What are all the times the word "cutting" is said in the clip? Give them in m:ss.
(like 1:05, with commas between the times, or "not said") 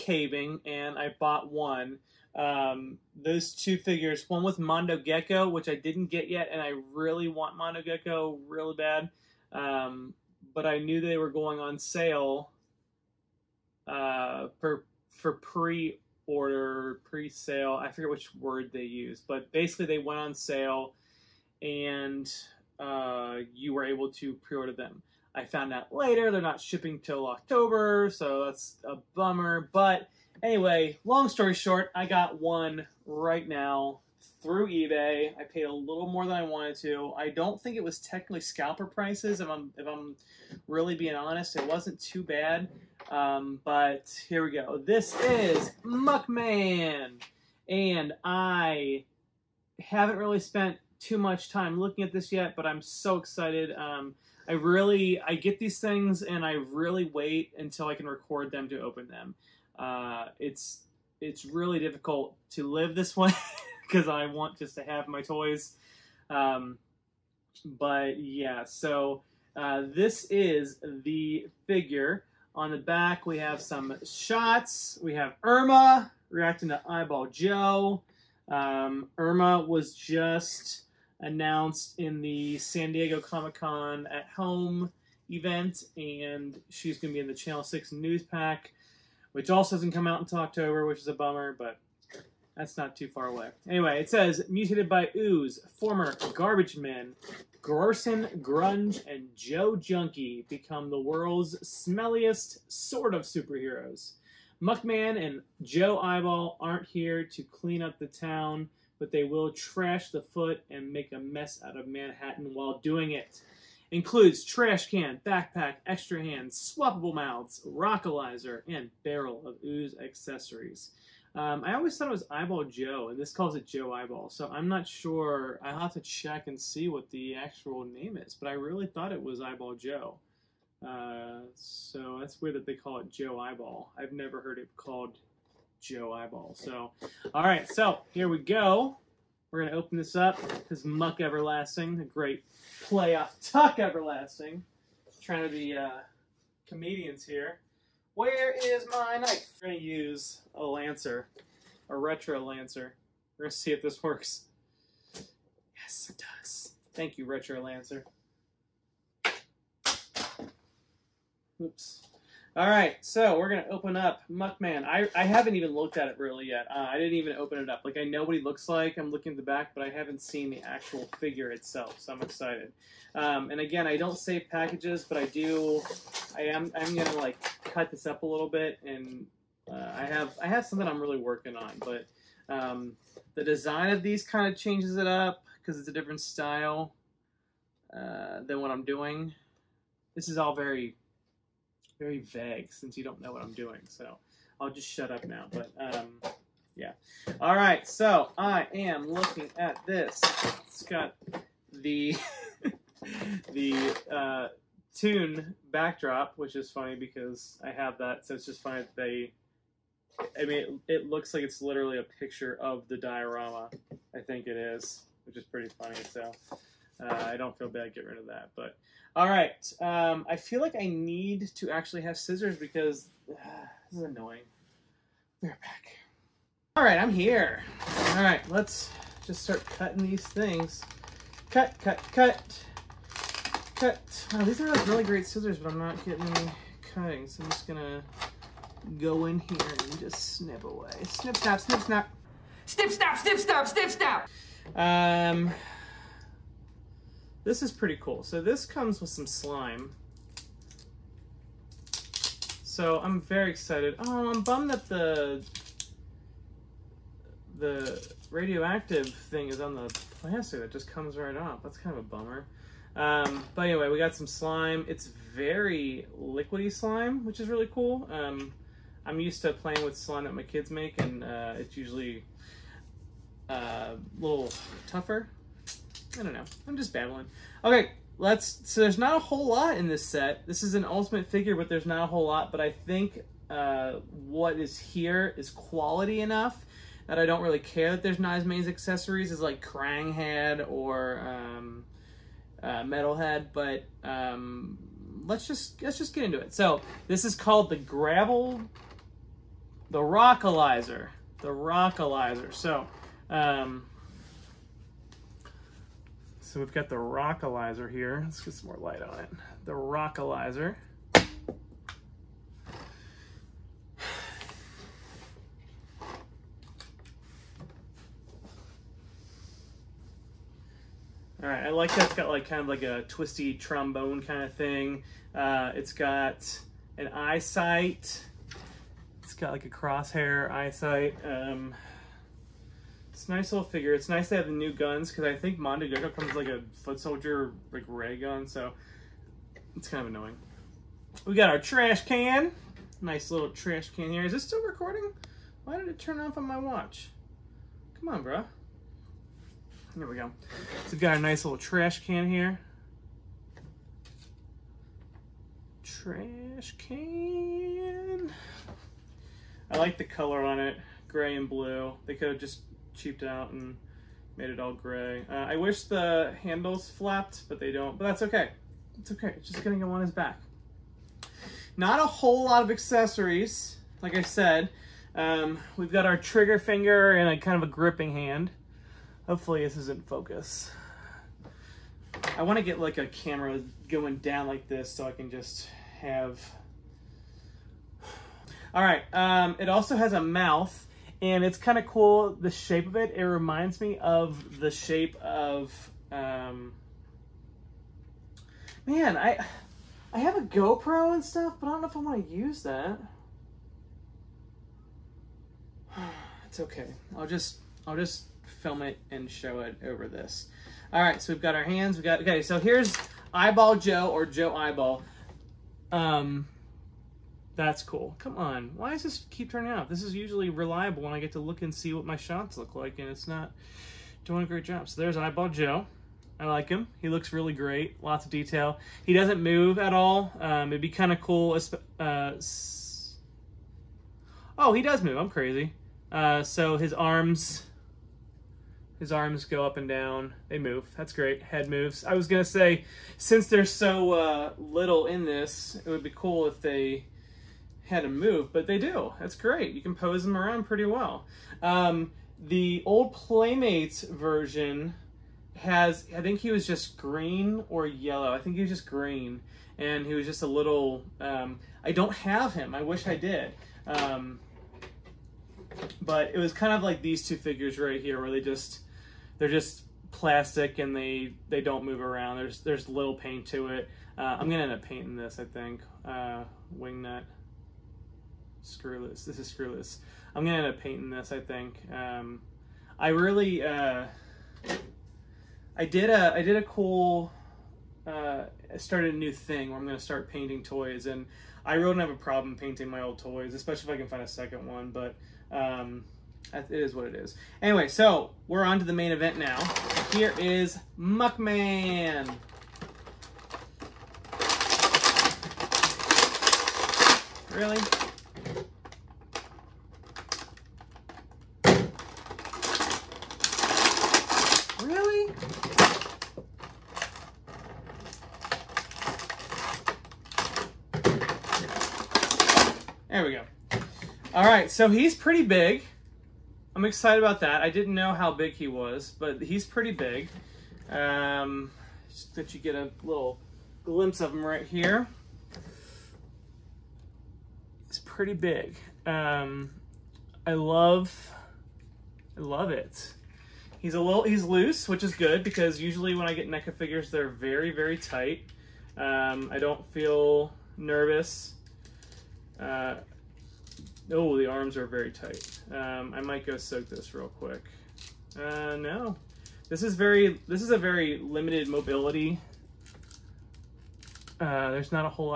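3:49, 3:56.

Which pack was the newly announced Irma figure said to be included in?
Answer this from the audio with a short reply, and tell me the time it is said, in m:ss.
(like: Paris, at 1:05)
Channel 6 news pack, at 1:27.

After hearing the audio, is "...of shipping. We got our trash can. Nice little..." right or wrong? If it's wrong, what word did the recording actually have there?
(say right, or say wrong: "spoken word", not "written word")
wrong: "annoying", not "shipping".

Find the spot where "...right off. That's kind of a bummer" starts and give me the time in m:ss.
4:21.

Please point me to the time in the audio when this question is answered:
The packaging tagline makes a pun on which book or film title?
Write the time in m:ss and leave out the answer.
2:23.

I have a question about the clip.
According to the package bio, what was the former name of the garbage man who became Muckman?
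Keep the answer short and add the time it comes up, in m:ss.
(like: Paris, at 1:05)
Garson Grunge, at 1:37.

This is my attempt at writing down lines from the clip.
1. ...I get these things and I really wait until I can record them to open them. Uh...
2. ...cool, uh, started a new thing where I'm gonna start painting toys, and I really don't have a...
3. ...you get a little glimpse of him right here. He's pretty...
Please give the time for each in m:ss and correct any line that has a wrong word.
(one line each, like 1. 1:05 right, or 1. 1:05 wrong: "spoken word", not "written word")
1. 0:55 right
2. 8:06 right
3. 8:52 right.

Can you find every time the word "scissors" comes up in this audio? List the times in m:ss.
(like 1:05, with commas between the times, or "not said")
3:42, 3:55.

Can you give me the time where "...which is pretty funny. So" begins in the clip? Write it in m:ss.
3:35.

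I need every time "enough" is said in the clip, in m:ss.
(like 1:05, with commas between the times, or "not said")
4:46.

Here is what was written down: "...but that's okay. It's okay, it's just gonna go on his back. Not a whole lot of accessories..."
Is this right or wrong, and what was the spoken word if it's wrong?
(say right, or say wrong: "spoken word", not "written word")
right.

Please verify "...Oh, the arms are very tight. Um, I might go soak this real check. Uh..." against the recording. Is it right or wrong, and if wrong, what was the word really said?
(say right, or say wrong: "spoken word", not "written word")
wrong: "quick", not "check".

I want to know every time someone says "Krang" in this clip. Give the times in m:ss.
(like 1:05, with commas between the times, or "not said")
4:49.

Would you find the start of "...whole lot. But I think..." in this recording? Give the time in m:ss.
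4:42.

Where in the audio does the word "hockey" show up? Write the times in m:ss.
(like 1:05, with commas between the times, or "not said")
not said.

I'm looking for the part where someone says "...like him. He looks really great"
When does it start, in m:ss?
7:06.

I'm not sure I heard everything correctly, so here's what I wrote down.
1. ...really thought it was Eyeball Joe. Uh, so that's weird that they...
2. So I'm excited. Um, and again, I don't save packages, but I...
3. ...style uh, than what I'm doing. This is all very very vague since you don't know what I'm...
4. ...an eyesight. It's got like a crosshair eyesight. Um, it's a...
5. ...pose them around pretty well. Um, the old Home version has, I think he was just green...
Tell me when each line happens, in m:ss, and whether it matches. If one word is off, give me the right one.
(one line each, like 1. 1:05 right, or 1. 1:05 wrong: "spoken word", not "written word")
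1. 2:08 right
2. 2:51 right
3. 3:06 right
4. 5:26 right
5. 7:29 wrong: "Playmates", not "Home".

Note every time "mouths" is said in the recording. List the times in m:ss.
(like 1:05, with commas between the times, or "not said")
1:57, 6:30.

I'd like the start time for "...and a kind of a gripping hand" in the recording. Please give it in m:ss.
6:17.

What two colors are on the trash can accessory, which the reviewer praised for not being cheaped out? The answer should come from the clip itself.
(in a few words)
Gray and blue.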